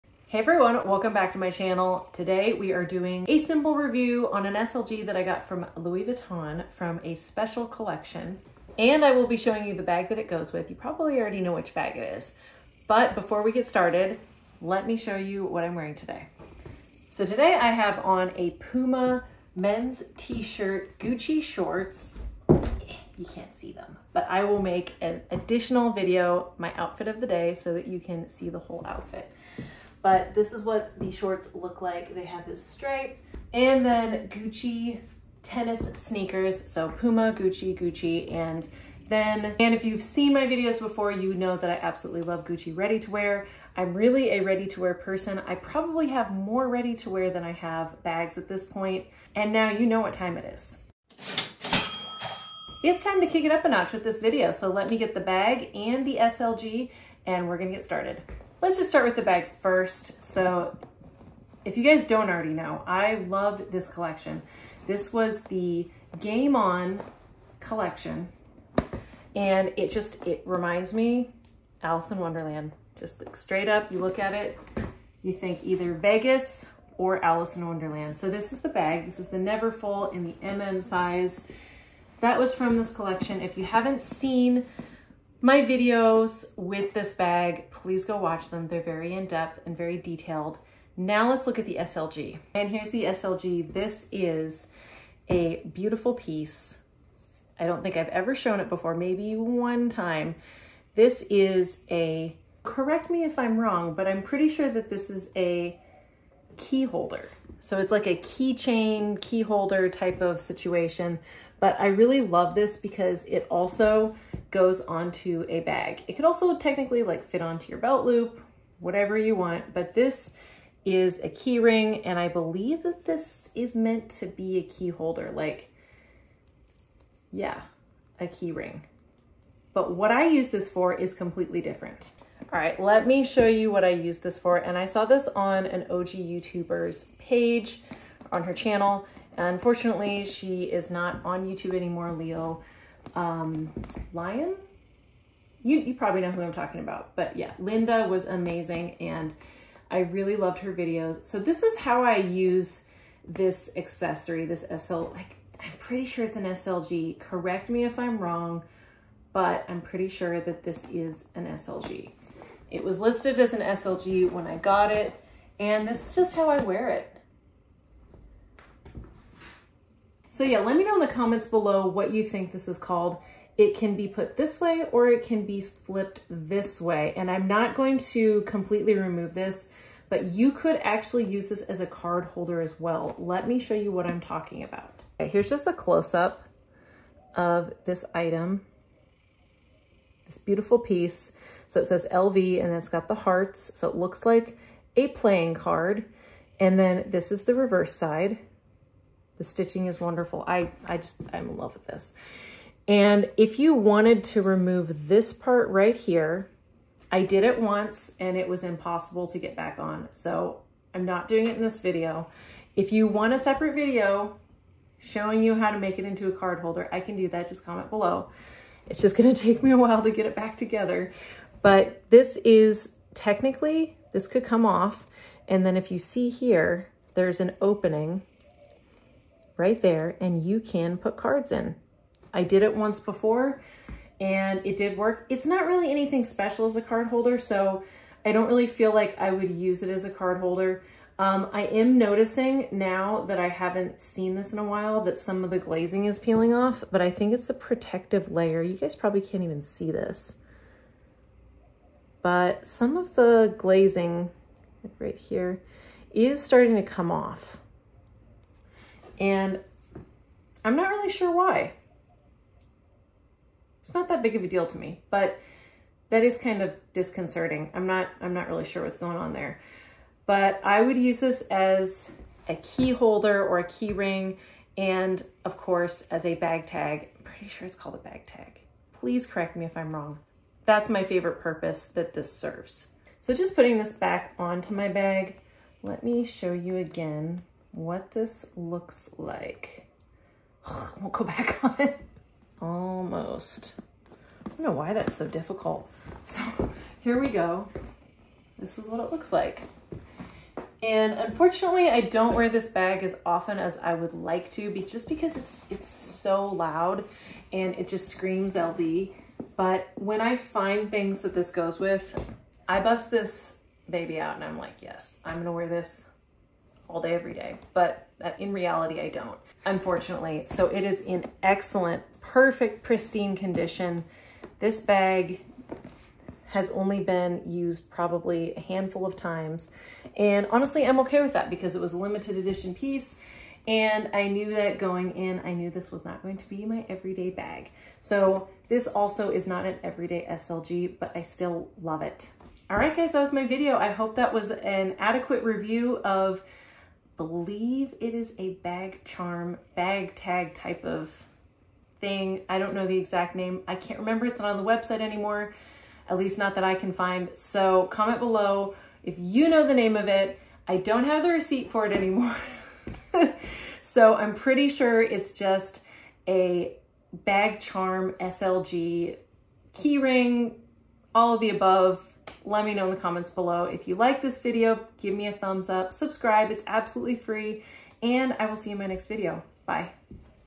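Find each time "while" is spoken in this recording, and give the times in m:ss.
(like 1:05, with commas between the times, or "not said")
3:39, 4:04.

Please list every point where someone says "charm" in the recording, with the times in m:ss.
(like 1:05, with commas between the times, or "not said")
5:49, 6:07.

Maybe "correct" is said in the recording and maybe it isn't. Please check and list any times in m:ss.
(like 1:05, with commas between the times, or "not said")
1:42, 2:37, 4:39.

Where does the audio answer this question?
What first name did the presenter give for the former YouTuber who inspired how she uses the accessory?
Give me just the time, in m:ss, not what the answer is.
2:27.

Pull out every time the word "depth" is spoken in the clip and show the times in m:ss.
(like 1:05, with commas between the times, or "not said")
1:29.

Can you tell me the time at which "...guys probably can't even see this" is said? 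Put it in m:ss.
4:08.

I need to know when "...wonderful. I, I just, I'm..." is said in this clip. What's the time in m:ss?
3:19.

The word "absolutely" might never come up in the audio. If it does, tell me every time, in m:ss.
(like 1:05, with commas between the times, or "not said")
0:41, 6:16.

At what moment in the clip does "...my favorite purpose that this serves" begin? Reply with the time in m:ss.
4:40.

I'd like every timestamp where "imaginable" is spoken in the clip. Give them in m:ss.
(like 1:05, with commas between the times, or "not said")
not said.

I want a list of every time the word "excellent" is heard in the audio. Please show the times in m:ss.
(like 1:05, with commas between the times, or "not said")
5:21.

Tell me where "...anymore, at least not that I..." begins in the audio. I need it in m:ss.
5:55.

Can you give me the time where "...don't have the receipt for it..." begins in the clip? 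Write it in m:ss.
6:00.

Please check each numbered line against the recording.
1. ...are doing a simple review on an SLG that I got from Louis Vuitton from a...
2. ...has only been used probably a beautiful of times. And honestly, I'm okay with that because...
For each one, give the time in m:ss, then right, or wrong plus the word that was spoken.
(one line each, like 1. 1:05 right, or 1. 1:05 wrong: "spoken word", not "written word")
1. 0:02 right
2. 5:26 wrong: "handful", not "beautiful".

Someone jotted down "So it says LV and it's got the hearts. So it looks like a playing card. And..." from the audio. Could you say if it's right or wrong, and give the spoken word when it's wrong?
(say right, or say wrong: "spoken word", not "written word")
right.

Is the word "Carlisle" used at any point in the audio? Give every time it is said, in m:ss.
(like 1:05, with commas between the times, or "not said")
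not said.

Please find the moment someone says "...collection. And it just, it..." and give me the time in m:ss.
1:07.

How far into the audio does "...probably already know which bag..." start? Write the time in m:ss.
0:10.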